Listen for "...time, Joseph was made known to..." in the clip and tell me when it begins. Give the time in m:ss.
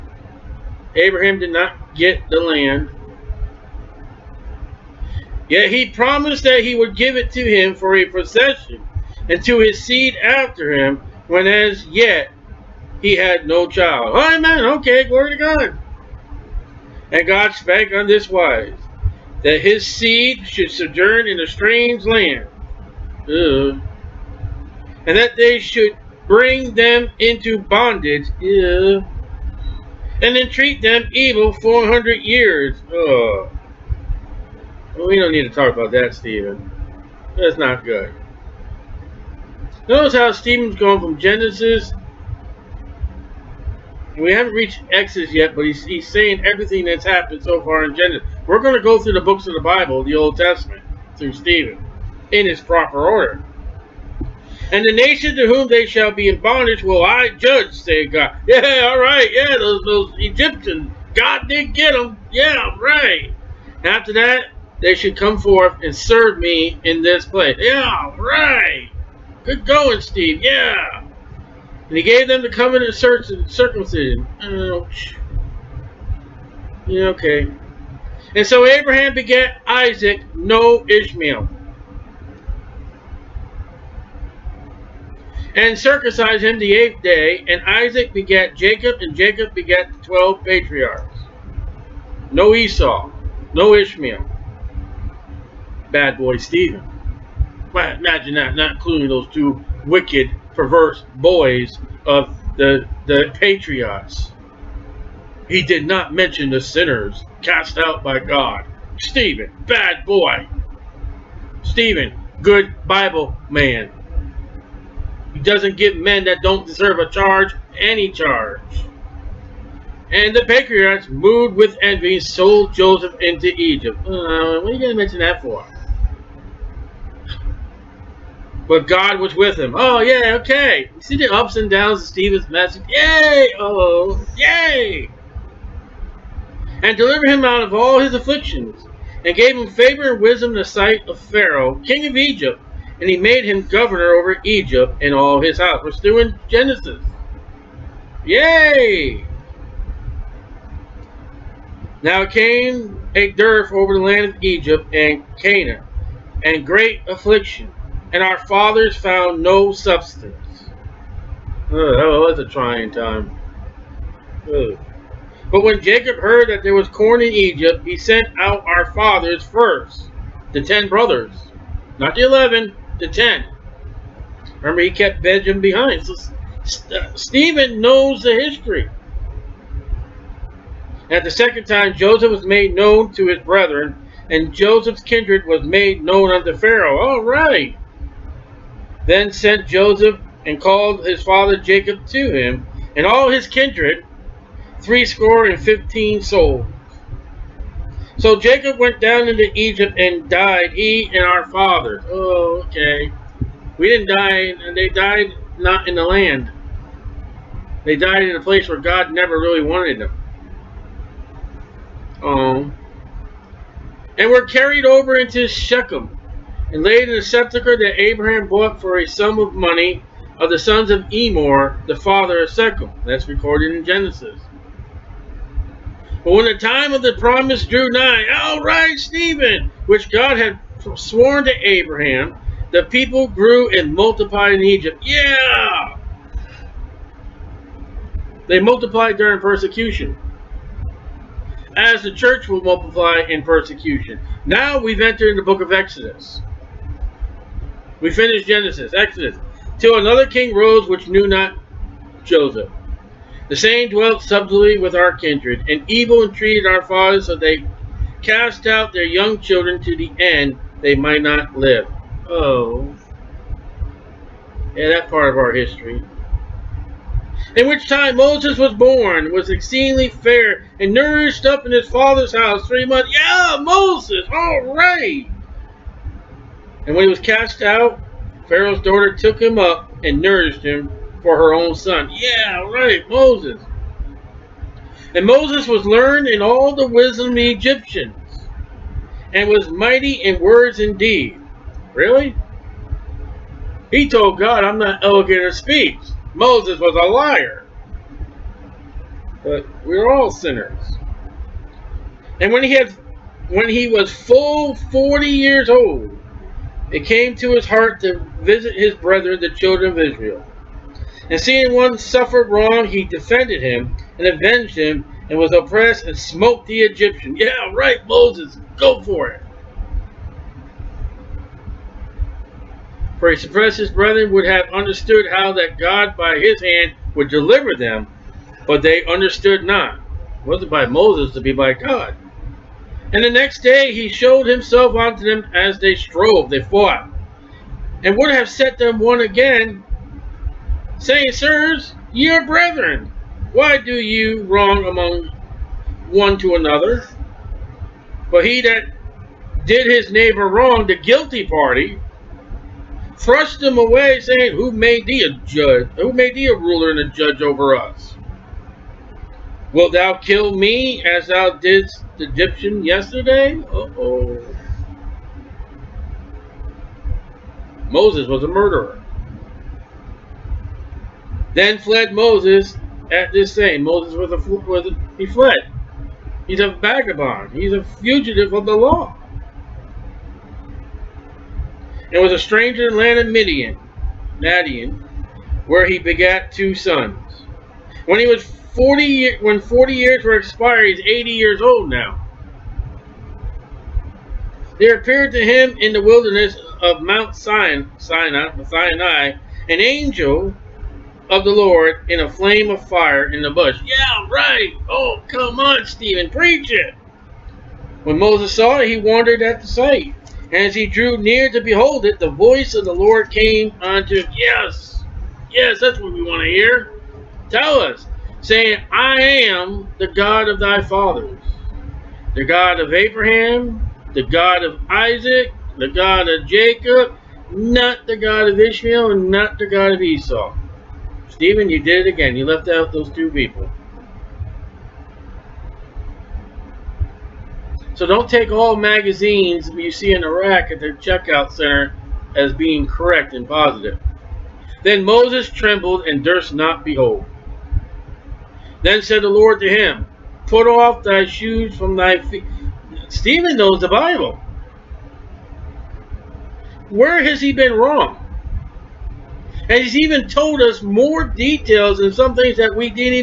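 3:01.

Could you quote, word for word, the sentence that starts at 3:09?
Then sent Joseph and called his father Jacob to him, and all his kindred, threescore and fifteen souls.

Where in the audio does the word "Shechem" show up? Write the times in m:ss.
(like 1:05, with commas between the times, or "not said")
3:35, 3:42.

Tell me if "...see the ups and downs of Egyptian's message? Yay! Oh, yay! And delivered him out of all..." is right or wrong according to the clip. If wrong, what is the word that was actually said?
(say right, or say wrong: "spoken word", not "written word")
wrong: "Stephen", not "Egyptian".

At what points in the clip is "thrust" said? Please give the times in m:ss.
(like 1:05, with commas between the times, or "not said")
5:53.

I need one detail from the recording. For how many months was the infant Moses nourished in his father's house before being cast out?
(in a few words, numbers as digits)
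3 months.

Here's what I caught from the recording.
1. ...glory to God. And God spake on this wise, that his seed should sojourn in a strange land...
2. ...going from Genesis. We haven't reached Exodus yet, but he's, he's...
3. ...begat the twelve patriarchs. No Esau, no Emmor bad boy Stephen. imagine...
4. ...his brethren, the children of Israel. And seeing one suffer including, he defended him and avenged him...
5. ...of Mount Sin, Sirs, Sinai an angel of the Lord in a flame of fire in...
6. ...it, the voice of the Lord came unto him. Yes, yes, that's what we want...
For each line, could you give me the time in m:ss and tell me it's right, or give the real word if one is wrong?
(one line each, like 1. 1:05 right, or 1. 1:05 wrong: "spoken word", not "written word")
1. 0:15 right
2. 0:40 right
3. 1:29 wrong: "Ishmael", not "Emmor"
4. 5:08 wrong: "wrong", not "including"
5. 6:36 wrong: "Sinai", not "Sirs"
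6. 6:52 right.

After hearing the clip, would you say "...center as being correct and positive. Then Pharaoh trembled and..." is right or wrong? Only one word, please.
wrong.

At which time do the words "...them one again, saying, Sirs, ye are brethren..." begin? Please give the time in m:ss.
5:38.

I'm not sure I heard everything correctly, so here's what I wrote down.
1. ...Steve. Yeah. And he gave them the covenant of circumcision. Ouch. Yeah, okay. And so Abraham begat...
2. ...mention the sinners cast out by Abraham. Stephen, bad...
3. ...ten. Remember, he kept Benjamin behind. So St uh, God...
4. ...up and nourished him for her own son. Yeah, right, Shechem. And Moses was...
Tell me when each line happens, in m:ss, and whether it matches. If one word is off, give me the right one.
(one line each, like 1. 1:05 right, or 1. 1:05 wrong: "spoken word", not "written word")
1. 1:10 right
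2. 1:46 wrong: "God", not "Abraham"
3. 2:53 wrong: "Stephen", not "God"
4. 4:39 wrong: "Moses", not "Shechem".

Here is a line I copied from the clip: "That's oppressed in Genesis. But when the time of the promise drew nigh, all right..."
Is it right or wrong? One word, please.
wrong.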